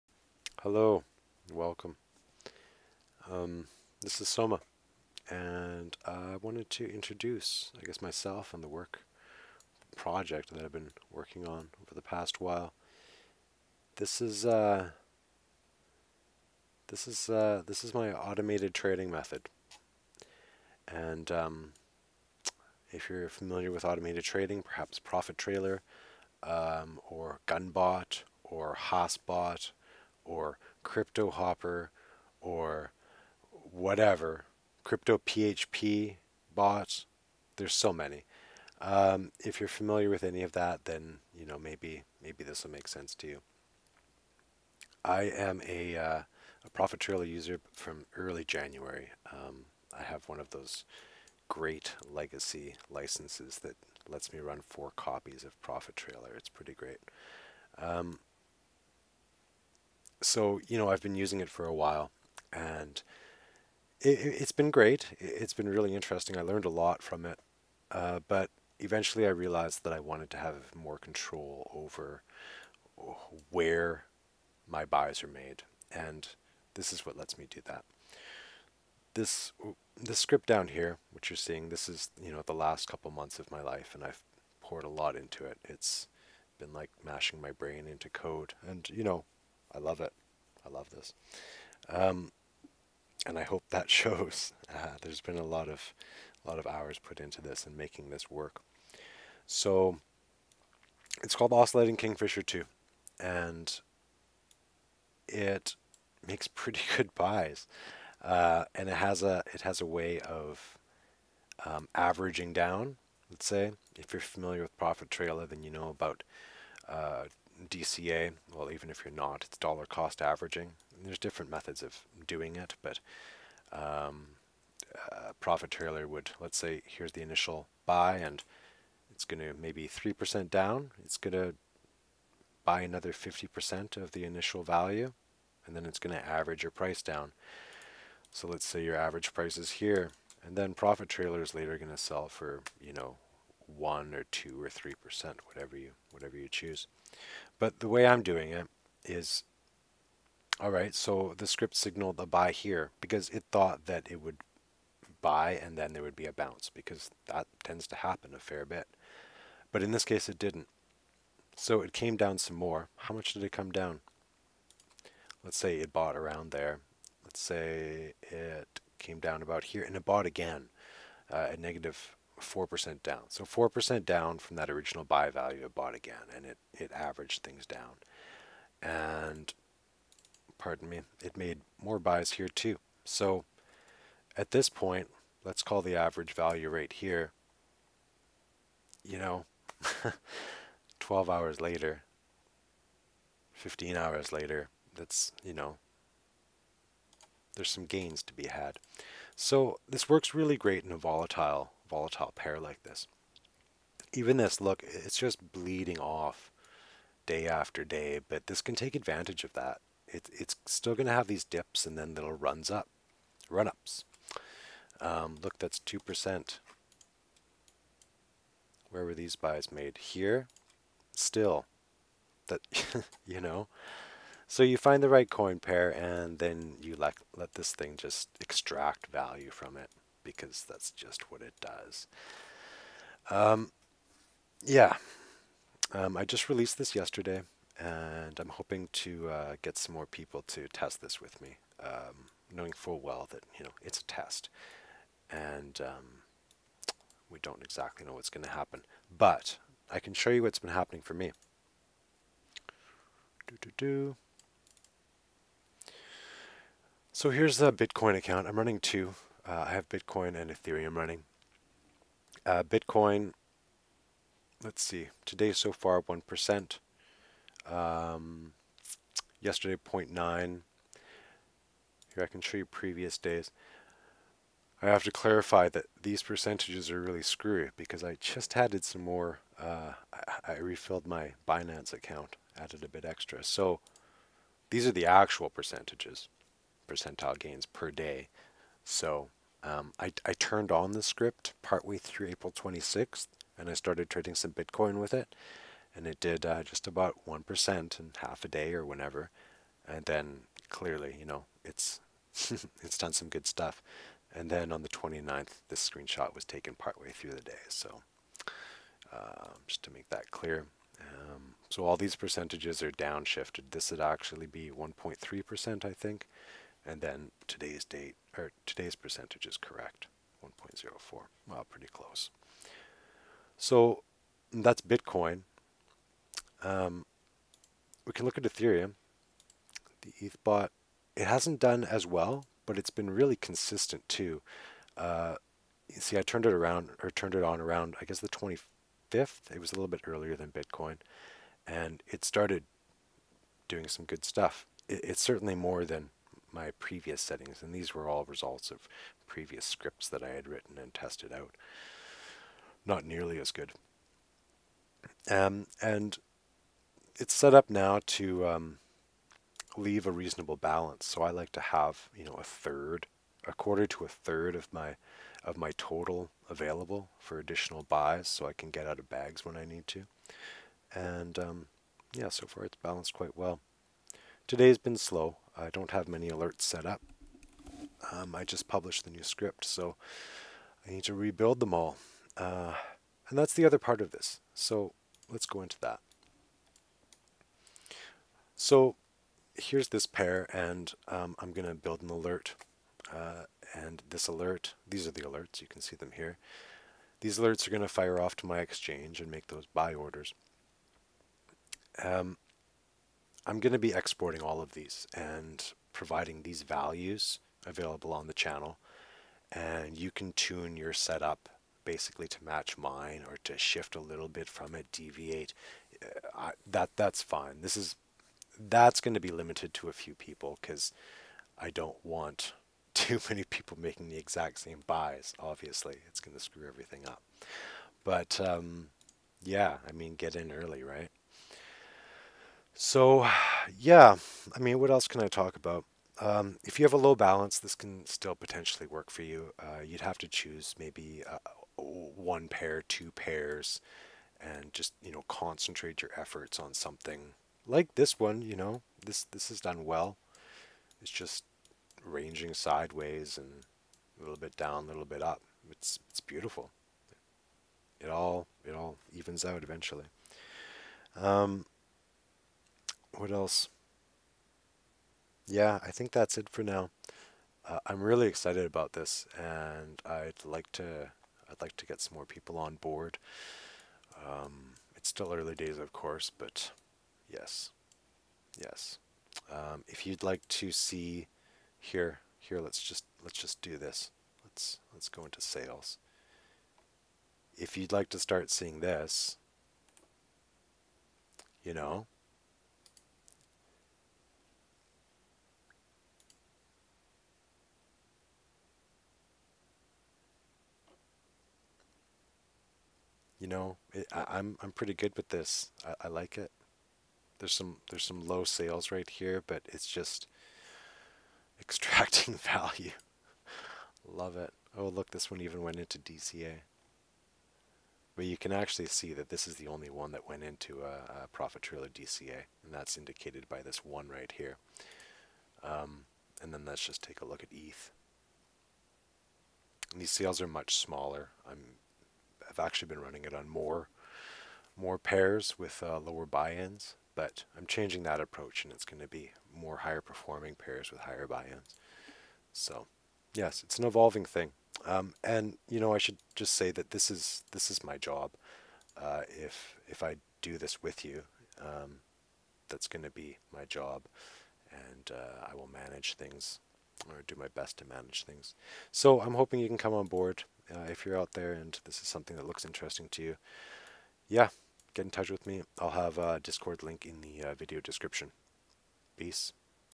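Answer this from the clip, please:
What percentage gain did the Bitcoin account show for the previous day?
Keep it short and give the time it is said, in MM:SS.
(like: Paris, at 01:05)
0.9%, at 04:29.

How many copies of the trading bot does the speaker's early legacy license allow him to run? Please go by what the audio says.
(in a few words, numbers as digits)
4.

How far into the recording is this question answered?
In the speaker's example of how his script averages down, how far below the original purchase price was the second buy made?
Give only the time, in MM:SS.
02:51.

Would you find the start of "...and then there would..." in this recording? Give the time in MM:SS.
02:35.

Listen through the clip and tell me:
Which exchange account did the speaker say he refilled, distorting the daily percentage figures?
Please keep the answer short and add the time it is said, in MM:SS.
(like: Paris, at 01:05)
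Binance, at 04:41.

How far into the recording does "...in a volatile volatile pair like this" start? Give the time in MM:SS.
03:20.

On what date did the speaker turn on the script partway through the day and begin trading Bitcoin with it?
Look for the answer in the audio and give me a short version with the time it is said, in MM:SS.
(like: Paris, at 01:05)
April 26, at 04:52.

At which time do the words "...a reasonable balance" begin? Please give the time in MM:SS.
06:00.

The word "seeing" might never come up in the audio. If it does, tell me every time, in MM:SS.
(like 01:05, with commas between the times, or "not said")
01:21, 08:08.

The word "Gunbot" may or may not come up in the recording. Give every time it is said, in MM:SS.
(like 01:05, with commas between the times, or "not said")
00:27.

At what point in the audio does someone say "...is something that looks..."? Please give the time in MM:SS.
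09:22.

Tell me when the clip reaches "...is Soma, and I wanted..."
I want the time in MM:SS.
00:04.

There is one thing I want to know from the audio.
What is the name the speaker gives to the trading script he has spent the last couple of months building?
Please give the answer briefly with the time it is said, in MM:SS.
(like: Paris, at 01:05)
Oscillating Kingfisher 2, at 01:41.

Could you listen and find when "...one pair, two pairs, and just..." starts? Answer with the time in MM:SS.
07:21.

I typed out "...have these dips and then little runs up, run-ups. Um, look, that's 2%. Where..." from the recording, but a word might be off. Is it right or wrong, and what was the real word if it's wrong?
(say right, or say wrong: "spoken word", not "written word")
right.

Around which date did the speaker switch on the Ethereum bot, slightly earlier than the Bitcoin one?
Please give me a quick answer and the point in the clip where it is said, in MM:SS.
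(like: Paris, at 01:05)
The 25th, at 05:38.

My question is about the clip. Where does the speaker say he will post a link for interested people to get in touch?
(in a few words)
Video description.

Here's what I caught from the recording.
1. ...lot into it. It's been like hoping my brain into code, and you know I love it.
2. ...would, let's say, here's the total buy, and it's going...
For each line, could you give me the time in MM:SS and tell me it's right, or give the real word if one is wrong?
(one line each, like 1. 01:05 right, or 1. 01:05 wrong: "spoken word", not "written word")
1. 01:24 wrong: "mashing", not "hoping"
2. 02:06 wrong: "initial", not "total".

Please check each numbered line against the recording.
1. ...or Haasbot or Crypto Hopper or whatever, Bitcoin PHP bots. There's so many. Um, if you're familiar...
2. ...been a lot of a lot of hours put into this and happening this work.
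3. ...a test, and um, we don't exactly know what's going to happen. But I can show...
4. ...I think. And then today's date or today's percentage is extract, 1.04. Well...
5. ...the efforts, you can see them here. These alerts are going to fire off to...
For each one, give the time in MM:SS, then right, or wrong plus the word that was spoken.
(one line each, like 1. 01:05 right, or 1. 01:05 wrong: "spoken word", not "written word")
1. 00:28 wrong: "Crypto", not "Bitcoin"
2. 01:35 wrong: "making", not "happening"
3. 04:03 right
4. 05:15 wrong: "correct", not "extract"
5. 06:35 wrong: "alerts", not "efforts".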